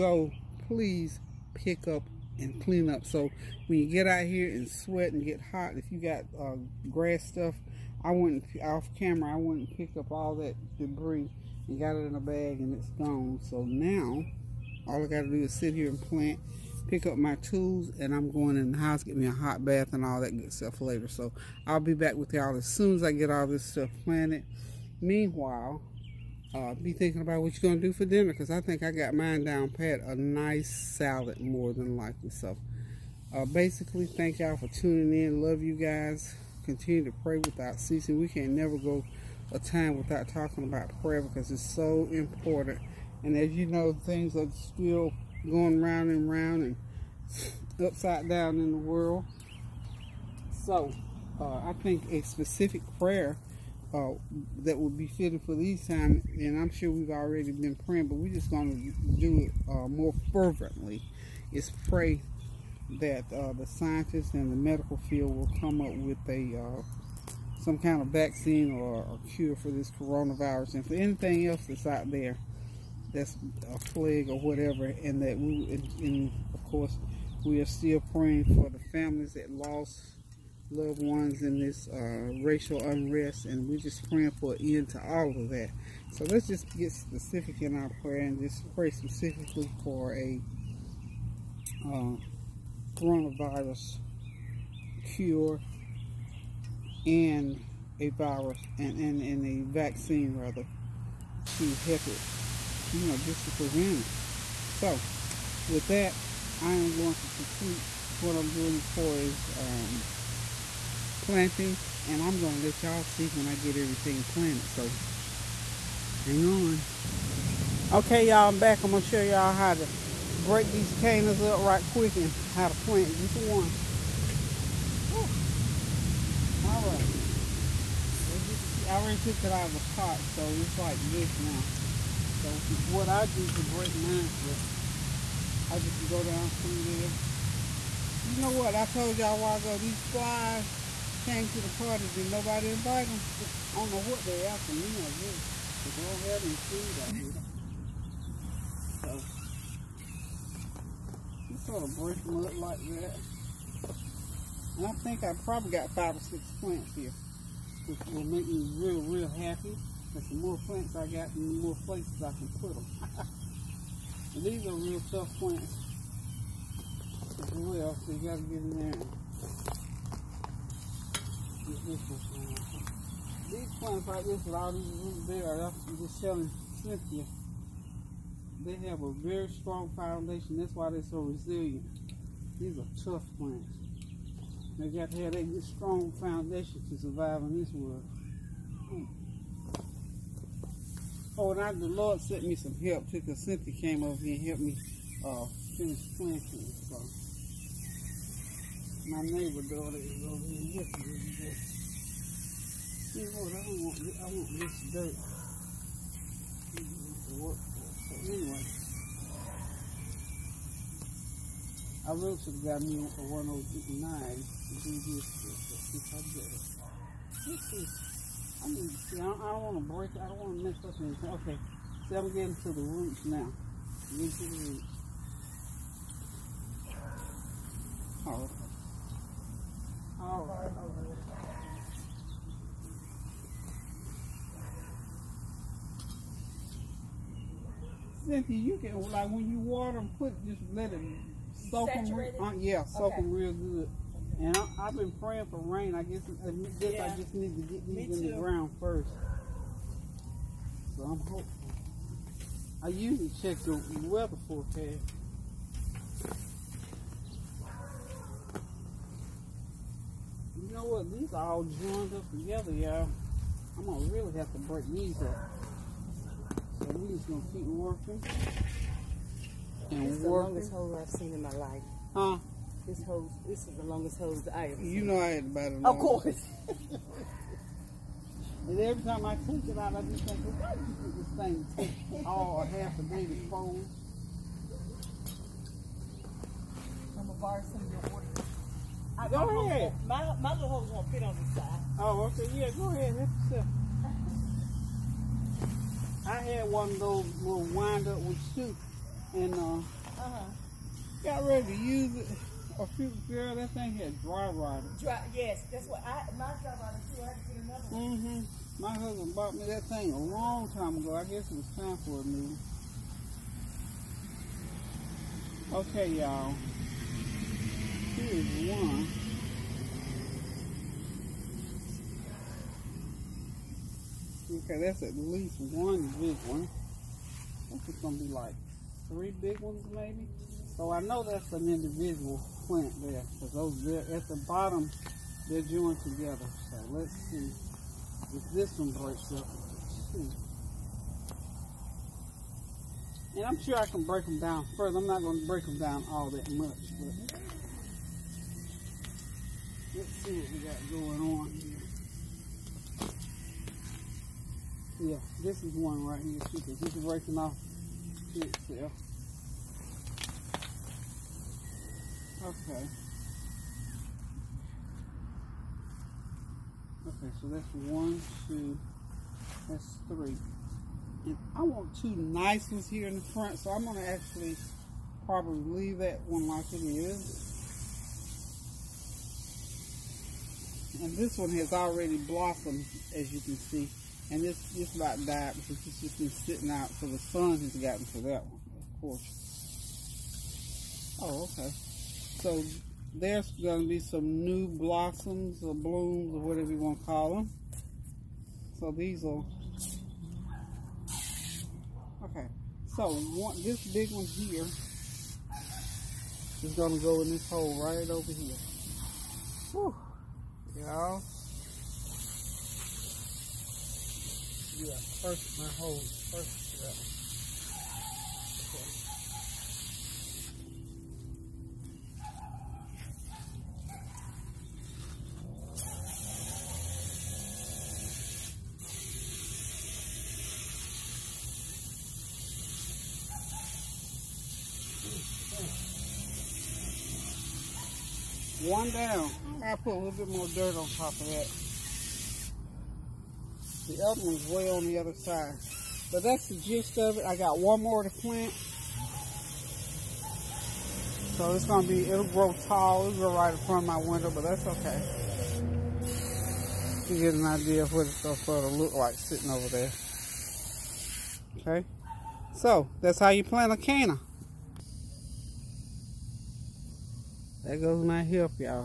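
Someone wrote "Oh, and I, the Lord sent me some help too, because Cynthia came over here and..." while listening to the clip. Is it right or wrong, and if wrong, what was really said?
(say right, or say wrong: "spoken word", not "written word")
right.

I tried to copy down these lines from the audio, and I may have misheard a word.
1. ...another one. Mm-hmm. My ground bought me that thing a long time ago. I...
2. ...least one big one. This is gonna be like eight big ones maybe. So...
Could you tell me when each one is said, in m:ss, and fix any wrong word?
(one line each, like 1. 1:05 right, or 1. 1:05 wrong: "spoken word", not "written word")
1. 5:07 wrong: "husband", not "ground"
2. 5:25 wrong: "three", not "eight".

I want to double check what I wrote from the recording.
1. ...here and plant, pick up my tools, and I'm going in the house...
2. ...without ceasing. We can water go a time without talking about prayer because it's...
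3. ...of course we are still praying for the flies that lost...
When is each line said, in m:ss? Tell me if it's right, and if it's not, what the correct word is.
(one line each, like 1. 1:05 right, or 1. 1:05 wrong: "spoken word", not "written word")
1. 0:15 right
2. 0:37 wrong: "never", not "water"
3. 1:16 wrong: "families", not "flies".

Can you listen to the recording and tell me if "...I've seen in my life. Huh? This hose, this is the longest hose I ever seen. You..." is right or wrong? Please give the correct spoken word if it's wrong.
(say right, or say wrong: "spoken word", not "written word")
right.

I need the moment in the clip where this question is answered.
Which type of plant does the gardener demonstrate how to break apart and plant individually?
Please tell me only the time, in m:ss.
2:00.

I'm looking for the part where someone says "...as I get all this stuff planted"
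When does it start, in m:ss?
0:22.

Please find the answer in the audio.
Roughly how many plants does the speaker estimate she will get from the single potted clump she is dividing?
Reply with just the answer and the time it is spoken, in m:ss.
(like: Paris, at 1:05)
5 or 6, at 2:35.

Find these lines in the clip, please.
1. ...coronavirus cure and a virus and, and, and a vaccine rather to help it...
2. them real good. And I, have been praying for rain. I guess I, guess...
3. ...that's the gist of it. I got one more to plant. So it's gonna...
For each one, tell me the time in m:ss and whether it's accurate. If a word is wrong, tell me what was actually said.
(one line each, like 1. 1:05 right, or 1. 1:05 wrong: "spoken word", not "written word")
1. 1:32 right
2. 4:03 right
3. 7:26 right.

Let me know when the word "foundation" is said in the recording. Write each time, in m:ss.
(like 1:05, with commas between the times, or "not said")
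2:59, 3:06.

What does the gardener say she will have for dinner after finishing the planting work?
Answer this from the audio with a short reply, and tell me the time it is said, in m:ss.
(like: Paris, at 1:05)
salad, at 0:30.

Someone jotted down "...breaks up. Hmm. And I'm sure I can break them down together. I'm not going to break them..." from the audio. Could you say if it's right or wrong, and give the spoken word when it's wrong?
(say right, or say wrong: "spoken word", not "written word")
wrong: "further", not "together".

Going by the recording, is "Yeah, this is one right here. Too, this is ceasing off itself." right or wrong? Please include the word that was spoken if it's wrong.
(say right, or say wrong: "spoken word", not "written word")
wrong: "racing", not "ceasing".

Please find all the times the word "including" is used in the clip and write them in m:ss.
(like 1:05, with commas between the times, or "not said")
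not said.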